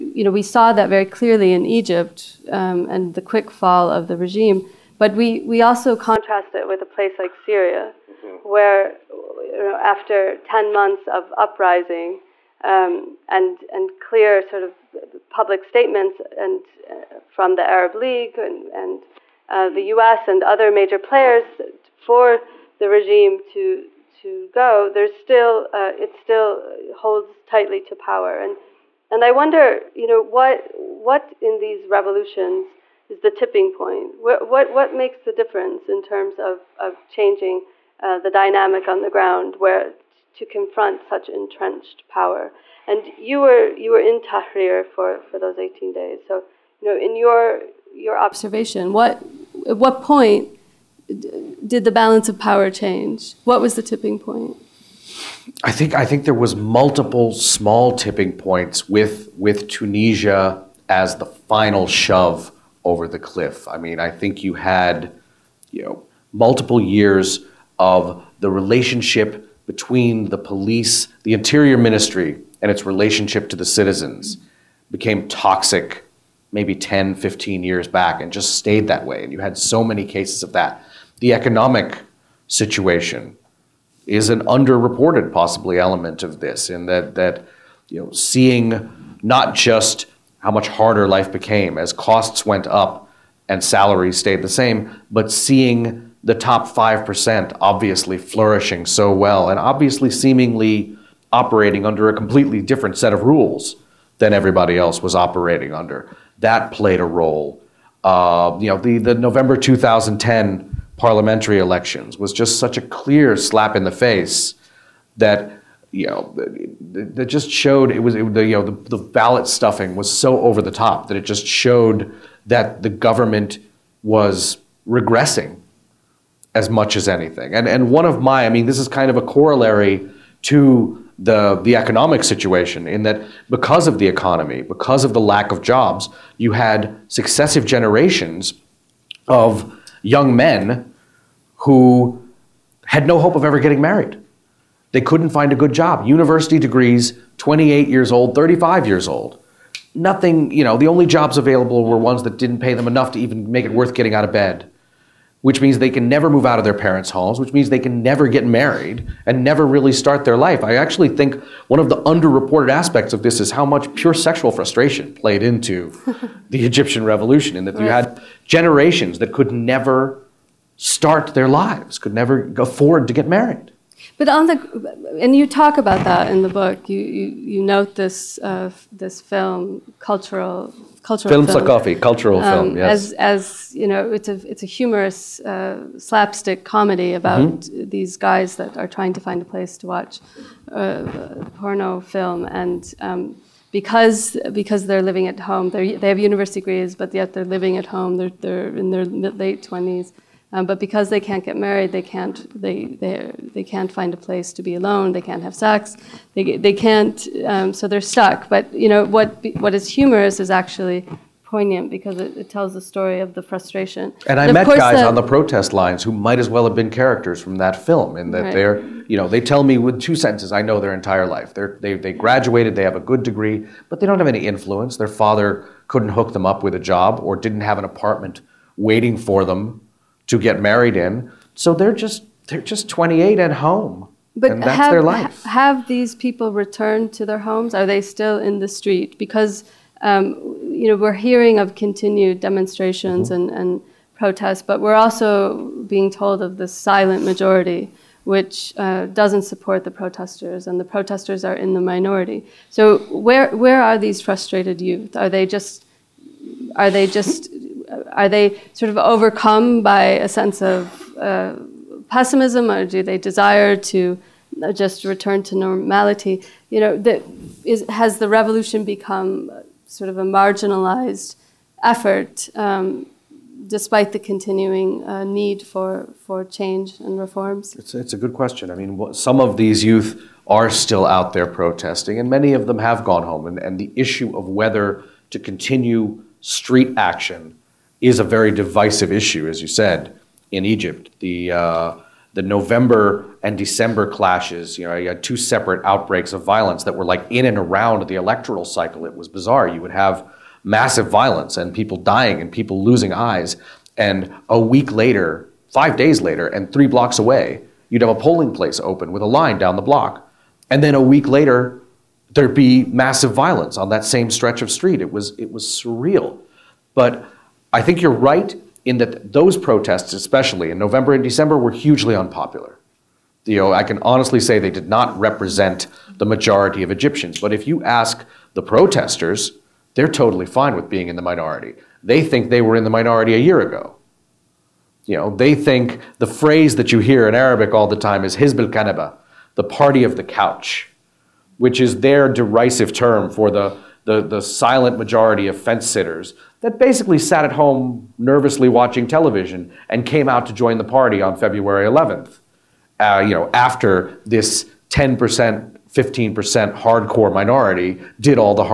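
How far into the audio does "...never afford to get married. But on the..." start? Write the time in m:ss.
2:52.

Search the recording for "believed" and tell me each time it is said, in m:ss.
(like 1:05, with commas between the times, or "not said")
not said.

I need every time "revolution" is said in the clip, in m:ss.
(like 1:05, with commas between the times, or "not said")
0:31, 2:47, 4:28.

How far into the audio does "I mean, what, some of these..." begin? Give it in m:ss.
4:38.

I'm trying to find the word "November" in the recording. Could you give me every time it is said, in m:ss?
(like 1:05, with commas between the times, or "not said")
1:49, 4:52, 5:20.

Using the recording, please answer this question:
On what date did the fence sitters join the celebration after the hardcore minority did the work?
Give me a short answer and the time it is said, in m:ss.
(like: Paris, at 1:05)
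February 11th, at 5:51.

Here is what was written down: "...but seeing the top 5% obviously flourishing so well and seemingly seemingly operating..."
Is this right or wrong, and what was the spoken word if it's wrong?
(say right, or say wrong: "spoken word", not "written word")
wrong: "obviously", not "seemingly".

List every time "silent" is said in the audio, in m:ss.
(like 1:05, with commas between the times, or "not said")
4:06, 5:44.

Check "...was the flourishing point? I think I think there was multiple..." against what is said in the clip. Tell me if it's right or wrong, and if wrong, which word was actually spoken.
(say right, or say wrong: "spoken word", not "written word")
wrong: "tipping", not "flourishing".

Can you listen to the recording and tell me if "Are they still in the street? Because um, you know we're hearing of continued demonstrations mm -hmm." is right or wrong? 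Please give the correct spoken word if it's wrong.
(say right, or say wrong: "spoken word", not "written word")
right.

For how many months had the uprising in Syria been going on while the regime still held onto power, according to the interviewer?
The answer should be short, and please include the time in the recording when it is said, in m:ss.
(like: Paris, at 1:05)
10, at 0:10.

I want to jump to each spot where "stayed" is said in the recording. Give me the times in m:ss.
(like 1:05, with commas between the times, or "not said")
1:18, 1:34.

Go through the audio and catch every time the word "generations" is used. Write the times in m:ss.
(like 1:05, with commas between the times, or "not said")
2:17, 2:48.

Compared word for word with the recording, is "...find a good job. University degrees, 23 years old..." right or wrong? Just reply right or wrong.
wrong.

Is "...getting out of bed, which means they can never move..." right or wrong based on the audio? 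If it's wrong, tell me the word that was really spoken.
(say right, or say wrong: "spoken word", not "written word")
right.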